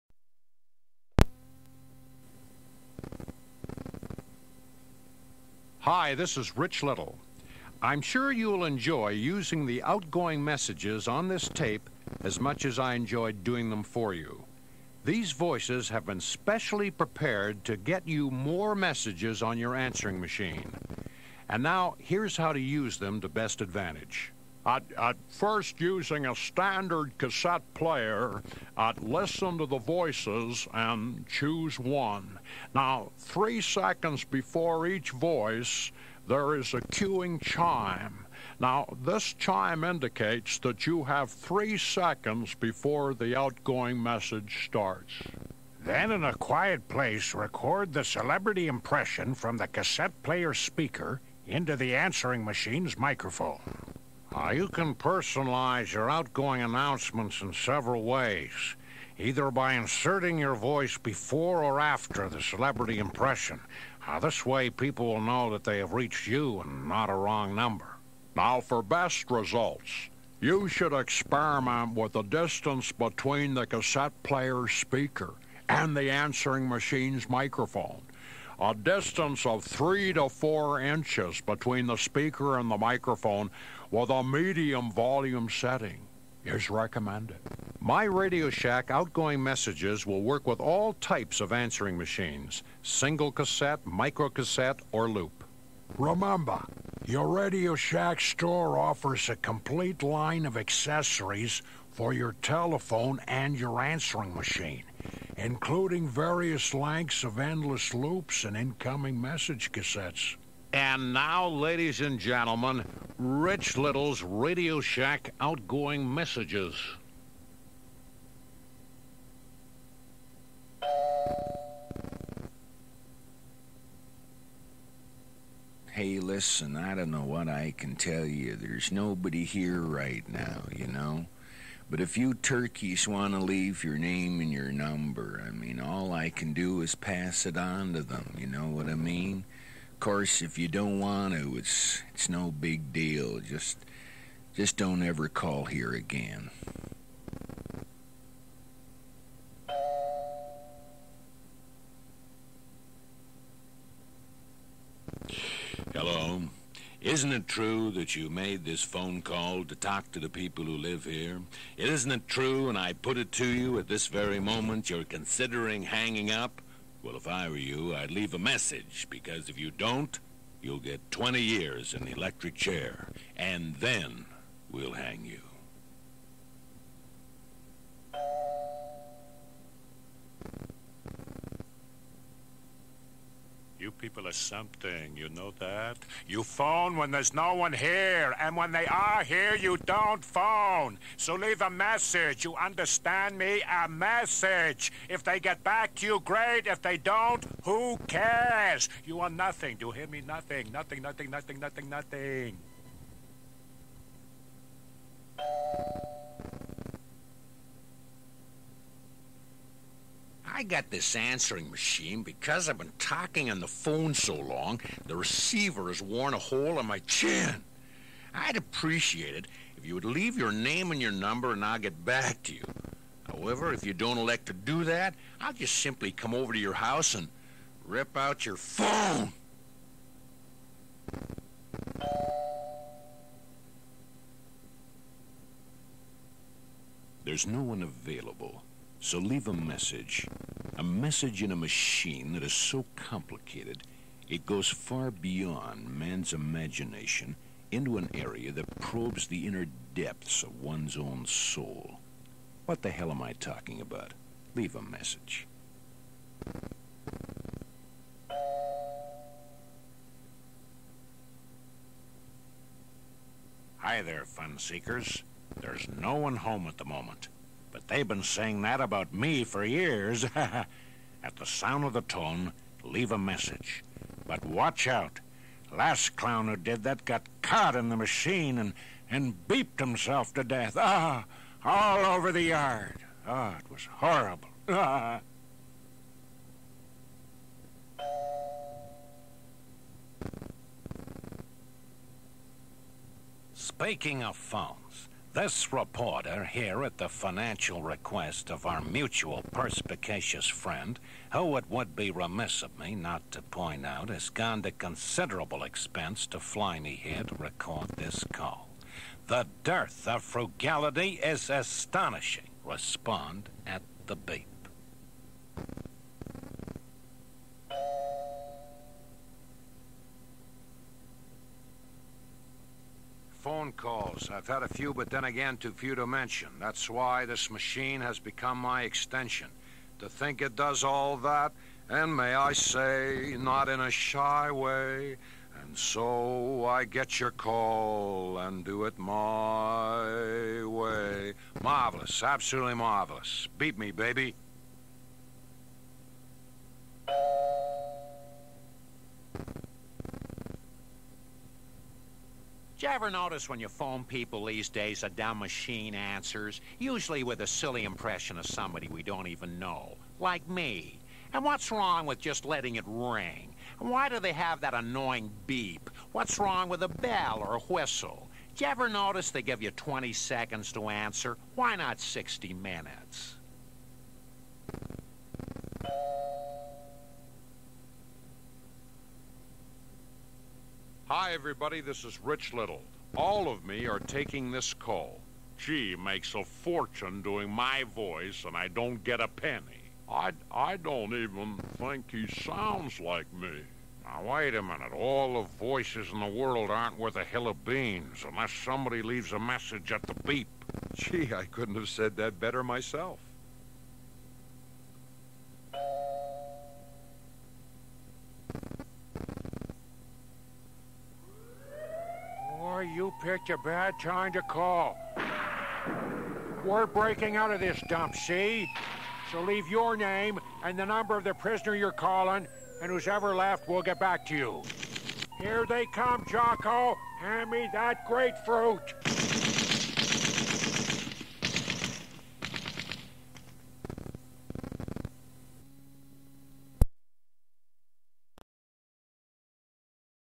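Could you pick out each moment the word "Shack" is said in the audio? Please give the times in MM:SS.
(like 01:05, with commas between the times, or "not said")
01:28, 01:37, 01:54.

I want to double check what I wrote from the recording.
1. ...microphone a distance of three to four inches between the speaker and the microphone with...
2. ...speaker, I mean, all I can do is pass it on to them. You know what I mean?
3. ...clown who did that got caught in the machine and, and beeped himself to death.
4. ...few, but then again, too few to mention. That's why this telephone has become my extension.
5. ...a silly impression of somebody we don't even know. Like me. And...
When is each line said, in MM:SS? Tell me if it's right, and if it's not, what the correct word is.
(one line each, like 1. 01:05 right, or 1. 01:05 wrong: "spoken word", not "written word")
1. 01:17 right
2. 02:14 wrong: "number", not "speaker"
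3. 04:36 right
4. 05:24 wrong: "machine", not "telephone"
5. 05:57 right.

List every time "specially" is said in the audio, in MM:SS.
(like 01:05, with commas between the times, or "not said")
00:16.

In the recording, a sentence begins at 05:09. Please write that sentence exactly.
The dearth of frugality is astonishing.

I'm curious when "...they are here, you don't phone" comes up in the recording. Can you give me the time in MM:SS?
03:08.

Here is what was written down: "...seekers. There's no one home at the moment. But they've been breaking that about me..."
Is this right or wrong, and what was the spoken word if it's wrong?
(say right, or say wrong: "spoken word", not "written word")
wrong: "saying", not "breaking".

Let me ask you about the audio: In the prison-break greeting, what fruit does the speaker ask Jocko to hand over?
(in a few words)
Grapefruit.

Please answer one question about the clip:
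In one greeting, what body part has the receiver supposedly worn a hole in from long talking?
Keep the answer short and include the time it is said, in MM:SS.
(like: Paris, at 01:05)
Chin, at 03:37.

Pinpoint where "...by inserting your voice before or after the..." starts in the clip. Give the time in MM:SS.
00:59.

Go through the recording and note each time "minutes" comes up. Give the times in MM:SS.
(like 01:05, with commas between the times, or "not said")
06:12, 06:34.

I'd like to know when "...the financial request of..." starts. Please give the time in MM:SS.
04:56.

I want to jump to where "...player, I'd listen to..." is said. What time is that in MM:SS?
00:27.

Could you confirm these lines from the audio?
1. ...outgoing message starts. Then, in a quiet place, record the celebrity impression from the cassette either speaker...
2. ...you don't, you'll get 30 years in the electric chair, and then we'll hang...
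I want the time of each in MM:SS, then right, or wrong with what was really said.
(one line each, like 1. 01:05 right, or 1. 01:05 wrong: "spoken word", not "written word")
1. 00:43 wrong: "player", not "either"
2. 02:49 wrong: "20", not "30".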